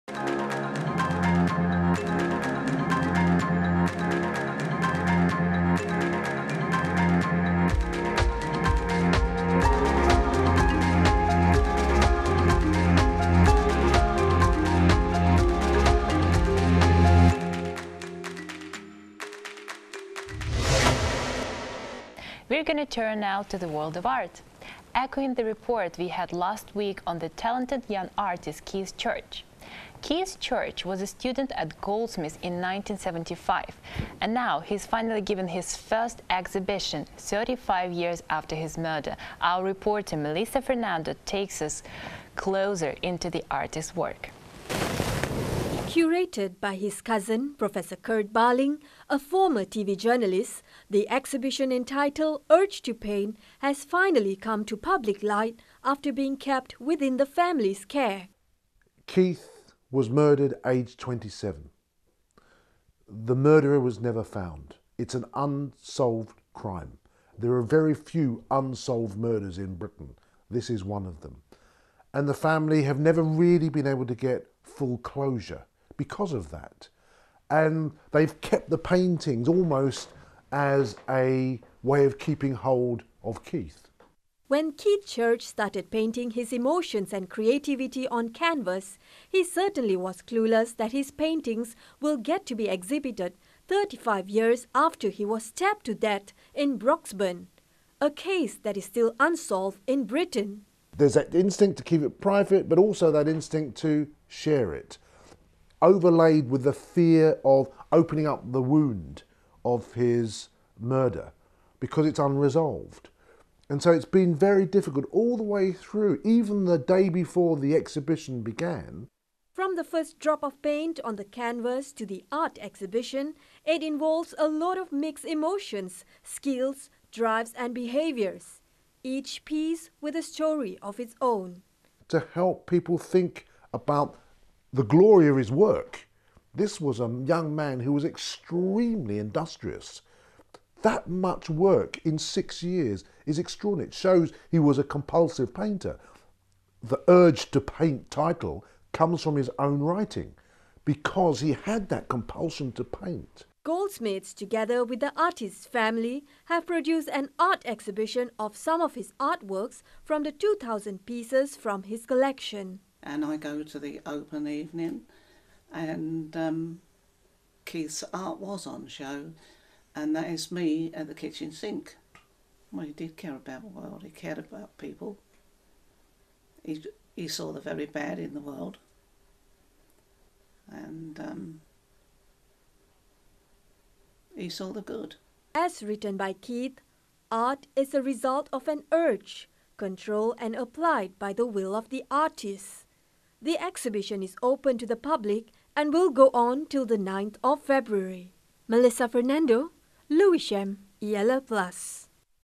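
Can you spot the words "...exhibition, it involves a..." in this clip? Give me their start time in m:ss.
2:02.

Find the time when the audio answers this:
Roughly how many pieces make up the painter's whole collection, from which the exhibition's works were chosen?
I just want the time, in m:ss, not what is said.
2:40.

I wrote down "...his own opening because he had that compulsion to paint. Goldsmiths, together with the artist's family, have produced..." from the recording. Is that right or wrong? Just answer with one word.
wrong.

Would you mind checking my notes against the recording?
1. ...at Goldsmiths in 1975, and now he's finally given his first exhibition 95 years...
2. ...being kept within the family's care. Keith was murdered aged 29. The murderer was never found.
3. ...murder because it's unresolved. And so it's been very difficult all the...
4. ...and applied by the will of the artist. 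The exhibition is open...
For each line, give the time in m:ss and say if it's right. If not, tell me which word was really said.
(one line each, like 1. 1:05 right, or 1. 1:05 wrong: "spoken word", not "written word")
1. 0:31 wrong: "35", not "95"
2. 0:56 wrong: "27", not "29"
3. 1:50 right
4. 3:10 right.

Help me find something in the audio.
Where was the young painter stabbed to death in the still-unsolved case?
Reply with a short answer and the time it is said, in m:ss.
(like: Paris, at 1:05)
Broxburn, at 1:36.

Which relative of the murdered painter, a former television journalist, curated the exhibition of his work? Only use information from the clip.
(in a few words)
Kurt Barling.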